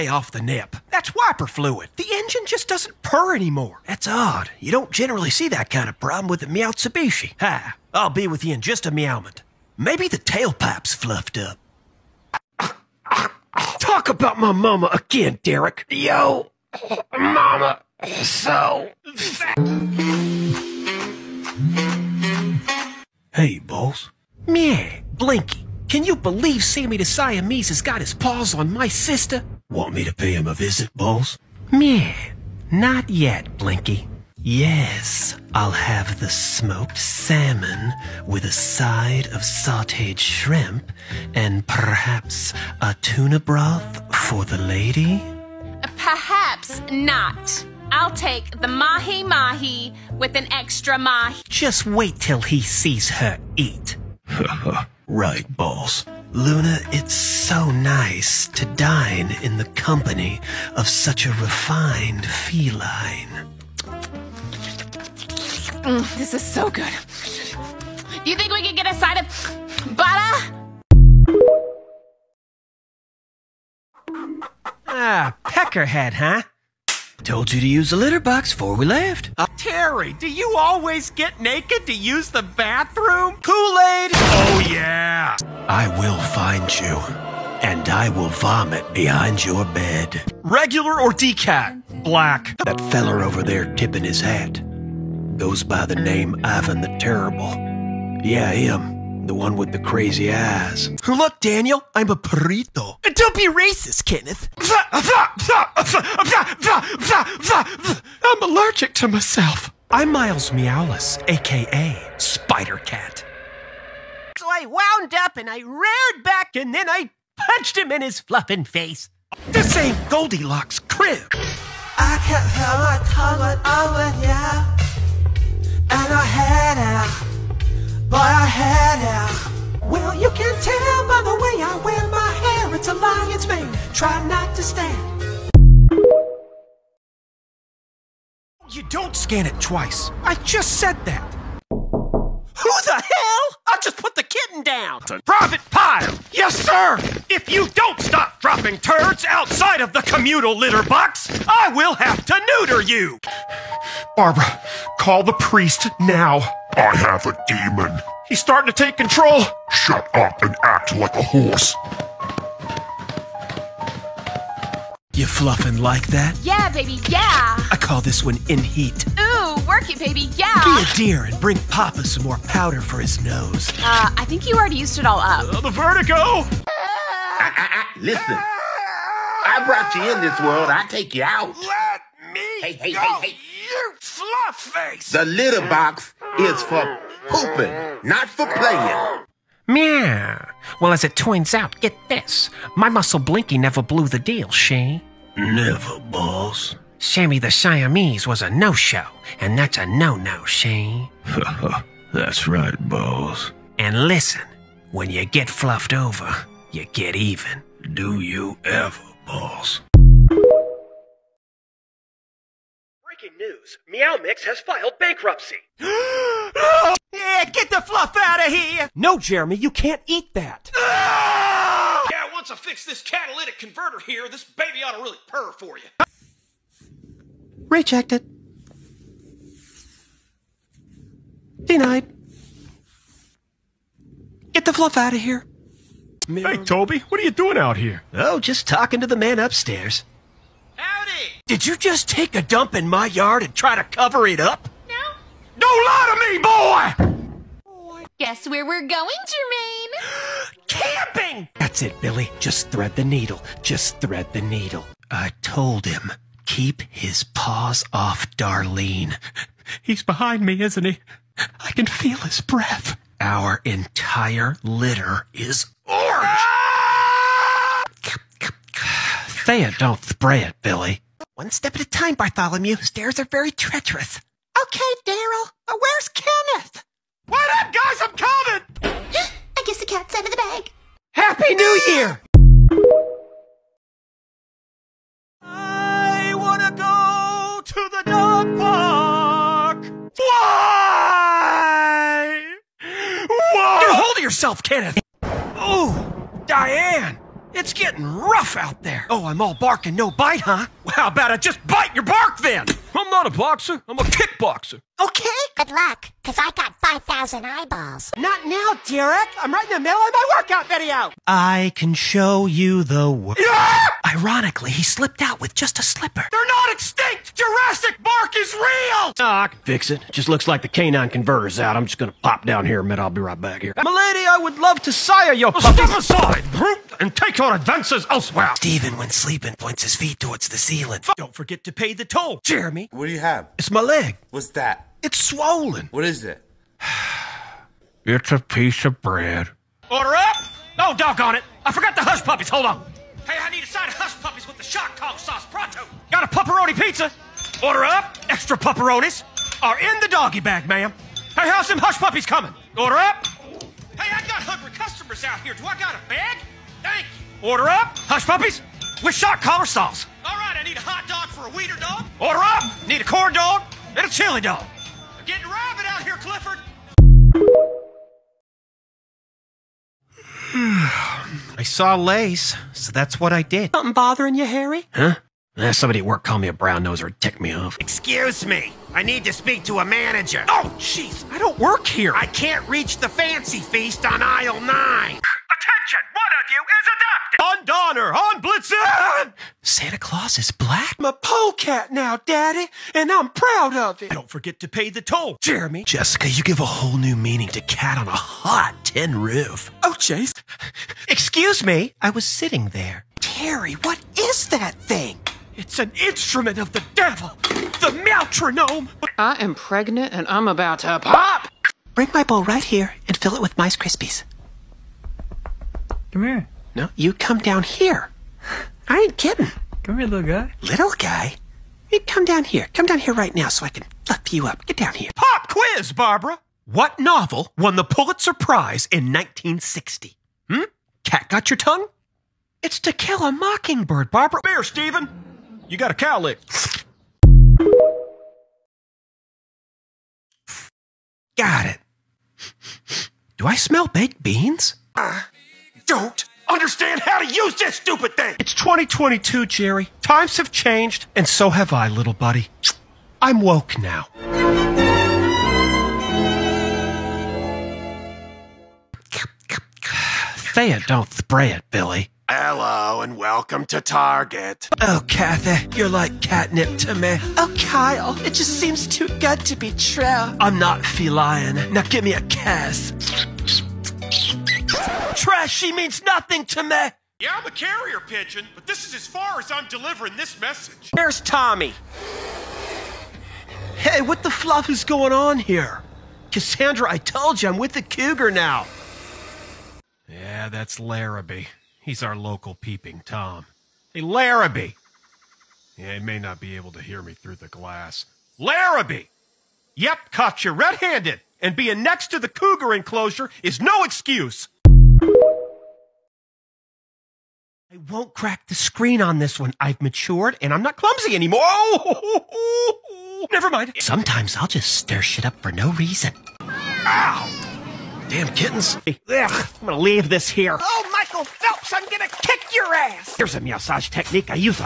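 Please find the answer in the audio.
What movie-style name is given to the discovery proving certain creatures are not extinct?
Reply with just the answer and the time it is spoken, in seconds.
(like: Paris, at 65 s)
Jurassic Bark, at 317 s.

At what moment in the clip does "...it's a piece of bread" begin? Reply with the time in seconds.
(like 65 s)
338 s.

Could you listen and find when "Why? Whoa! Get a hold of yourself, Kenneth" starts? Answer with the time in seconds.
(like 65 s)
290 s.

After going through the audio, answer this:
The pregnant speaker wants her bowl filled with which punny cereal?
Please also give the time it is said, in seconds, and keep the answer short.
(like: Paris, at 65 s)
Mice Krispies, at 413 s.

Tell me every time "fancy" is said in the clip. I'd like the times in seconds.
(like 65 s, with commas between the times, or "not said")
383 s.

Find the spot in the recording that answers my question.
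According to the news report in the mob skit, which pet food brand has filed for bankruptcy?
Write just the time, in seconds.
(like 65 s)
213 s.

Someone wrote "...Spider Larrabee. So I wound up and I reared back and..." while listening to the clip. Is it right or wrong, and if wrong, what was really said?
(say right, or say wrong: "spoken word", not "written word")
wrong: "Cat", not "Larrabee".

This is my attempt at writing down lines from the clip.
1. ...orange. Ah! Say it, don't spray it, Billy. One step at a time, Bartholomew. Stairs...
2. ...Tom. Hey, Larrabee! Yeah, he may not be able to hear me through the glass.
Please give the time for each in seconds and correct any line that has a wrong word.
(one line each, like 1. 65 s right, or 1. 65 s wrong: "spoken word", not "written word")
1. 265 s right
2. 493 s right.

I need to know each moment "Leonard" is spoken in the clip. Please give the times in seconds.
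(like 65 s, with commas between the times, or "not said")
not said.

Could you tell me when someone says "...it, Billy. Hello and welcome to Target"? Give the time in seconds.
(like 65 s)
461 s.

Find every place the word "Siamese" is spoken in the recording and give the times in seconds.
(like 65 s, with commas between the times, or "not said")
27 s, 197 s.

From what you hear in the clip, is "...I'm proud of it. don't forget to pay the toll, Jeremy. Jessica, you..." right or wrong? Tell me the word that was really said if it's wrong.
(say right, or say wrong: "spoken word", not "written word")
right.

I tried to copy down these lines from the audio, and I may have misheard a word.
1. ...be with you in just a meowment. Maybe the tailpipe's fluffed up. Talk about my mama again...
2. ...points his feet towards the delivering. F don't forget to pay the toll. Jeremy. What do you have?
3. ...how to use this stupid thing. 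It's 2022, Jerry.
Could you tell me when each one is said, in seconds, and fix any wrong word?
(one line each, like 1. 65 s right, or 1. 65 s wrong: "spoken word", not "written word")
1. 8 s right
2. 329 s wrong: "ceiling", not "delivering"
3. 447 s right.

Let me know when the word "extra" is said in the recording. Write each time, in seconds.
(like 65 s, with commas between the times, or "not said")
50 s, 348 s.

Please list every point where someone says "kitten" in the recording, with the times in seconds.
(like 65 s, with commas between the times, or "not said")
144 s, 518 s.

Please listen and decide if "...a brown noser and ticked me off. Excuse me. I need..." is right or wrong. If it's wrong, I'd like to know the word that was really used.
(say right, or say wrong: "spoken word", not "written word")
right.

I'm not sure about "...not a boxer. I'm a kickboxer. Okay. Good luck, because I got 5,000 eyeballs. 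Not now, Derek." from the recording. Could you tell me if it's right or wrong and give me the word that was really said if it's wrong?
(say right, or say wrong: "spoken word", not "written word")
right.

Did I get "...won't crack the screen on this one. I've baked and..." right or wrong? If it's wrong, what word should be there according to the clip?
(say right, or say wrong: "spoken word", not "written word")
wrong: "matured", not "baked".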